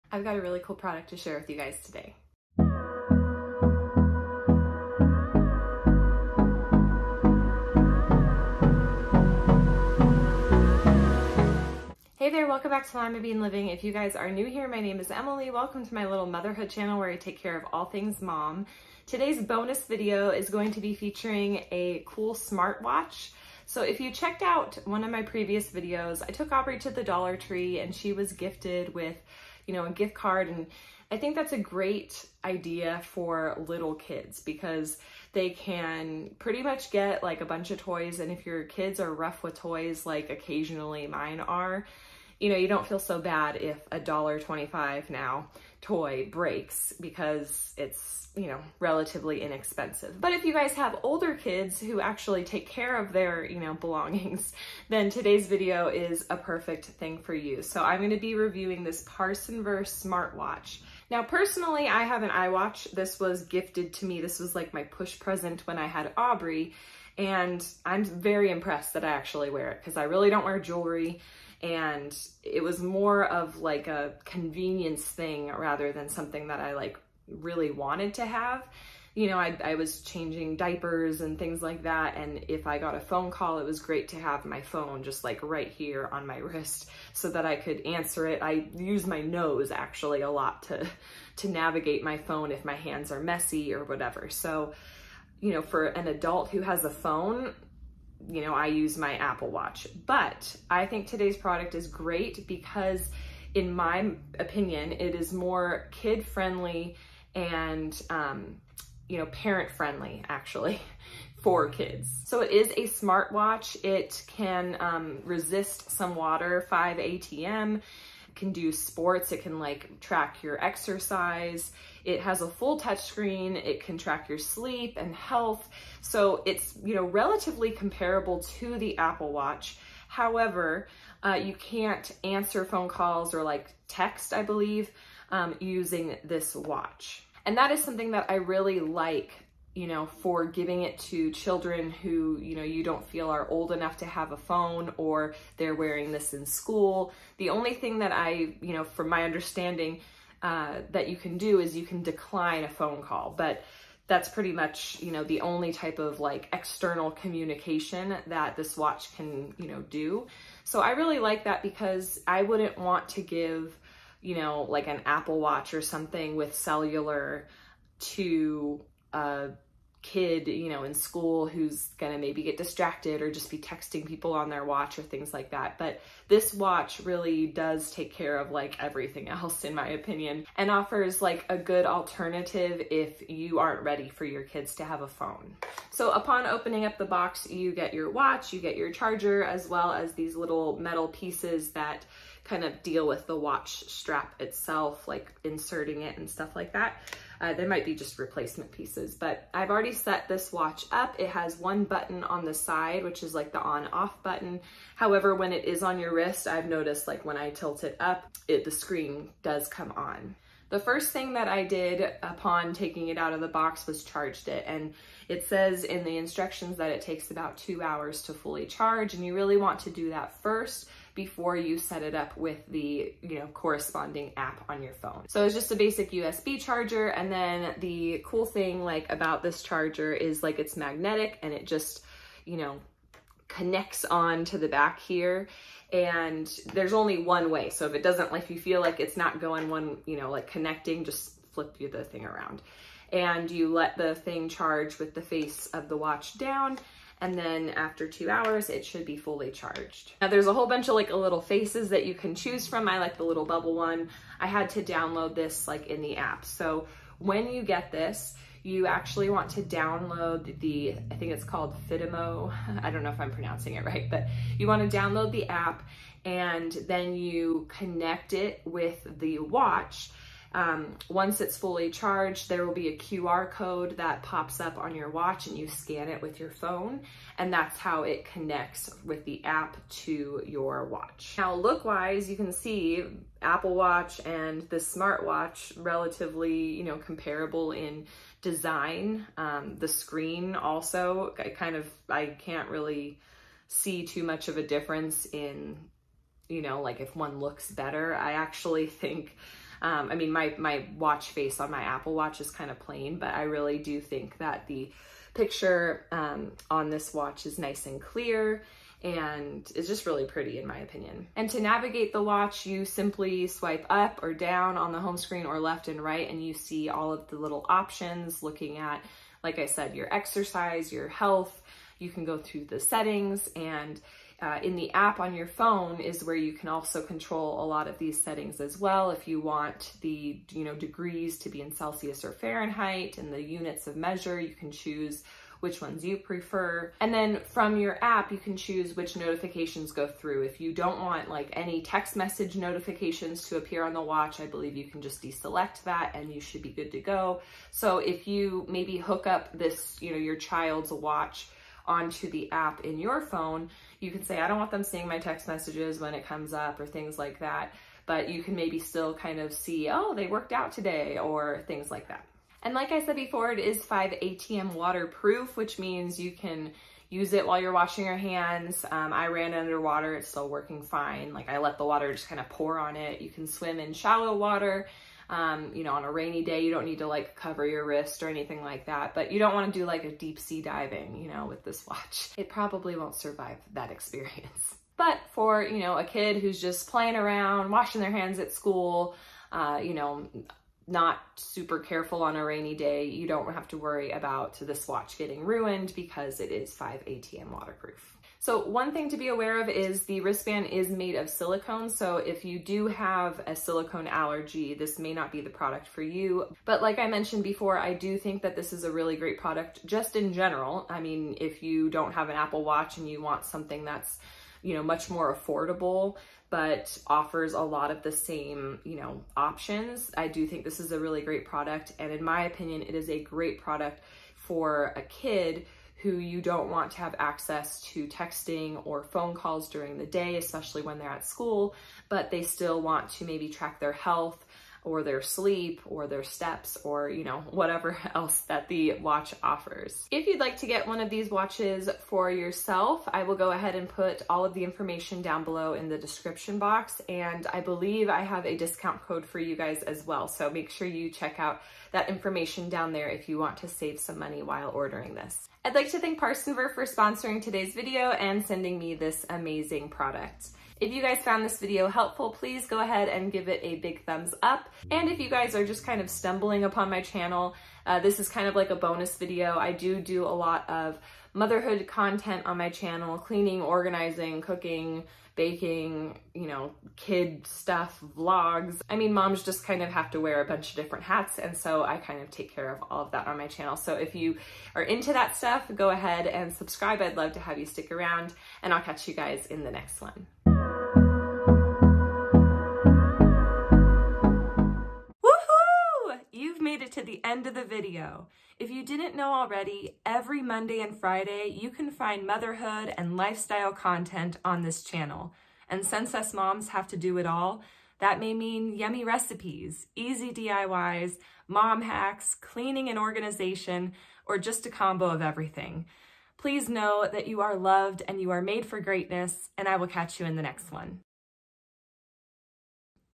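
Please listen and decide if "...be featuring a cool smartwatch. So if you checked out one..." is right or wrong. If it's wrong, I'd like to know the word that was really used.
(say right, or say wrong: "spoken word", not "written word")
right.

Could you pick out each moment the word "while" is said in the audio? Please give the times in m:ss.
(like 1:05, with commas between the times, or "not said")
6:07, 7:34.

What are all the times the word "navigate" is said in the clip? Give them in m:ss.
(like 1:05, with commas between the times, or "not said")
1:31, 5:11.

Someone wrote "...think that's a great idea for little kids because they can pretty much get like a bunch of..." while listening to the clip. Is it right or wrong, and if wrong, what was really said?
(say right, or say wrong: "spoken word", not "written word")
right.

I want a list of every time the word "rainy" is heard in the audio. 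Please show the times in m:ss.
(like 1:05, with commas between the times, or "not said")
6:16, 6:32.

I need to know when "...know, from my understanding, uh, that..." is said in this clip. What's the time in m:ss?
2:28.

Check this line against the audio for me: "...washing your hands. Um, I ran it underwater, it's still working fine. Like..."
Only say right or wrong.
right.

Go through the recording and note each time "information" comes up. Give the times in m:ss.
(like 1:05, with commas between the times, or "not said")
7:24, 7:32.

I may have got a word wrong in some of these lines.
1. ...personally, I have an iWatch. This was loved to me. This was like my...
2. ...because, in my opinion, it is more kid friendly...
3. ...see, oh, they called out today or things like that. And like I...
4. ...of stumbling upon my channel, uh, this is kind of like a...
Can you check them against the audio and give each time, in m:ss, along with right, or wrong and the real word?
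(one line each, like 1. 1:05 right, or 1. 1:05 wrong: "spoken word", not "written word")
1. 1:01 wrong: "gifted", not "loved"
2. 1:42 right
3. 5:59 wrong: "worked", not "called"
4. 7:46 right.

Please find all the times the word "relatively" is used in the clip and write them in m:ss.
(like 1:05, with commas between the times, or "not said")
0:48, 2:07, 4:45.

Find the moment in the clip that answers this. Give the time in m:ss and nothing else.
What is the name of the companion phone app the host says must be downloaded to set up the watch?
4:21.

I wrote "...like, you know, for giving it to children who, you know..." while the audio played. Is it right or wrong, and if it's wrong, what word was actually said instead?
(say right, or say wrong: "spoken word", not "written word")
right.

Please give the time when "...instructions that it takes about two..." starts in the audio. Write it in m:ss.
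3:36.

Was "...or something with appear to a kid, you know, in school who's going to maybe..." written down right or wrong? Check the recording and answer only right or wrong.
wrong.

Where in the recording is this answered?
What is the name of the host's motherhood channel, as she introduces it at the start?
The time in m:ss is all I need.
0:12.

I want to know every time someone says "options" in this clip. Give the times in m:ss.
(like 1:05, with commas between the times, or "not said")
5:17, 6:59.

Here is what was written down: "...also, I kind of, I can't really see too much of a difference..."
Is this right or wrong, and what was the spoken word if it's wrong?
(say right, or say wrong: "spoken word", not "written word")
right.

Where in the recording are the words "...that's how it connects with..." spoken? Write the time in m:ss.
4:37.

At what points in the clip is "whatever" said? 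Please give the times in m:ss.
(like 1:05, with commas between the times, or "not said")
1:33, 7:17.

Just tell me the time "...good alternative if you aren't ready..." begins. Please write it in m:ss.
3:01.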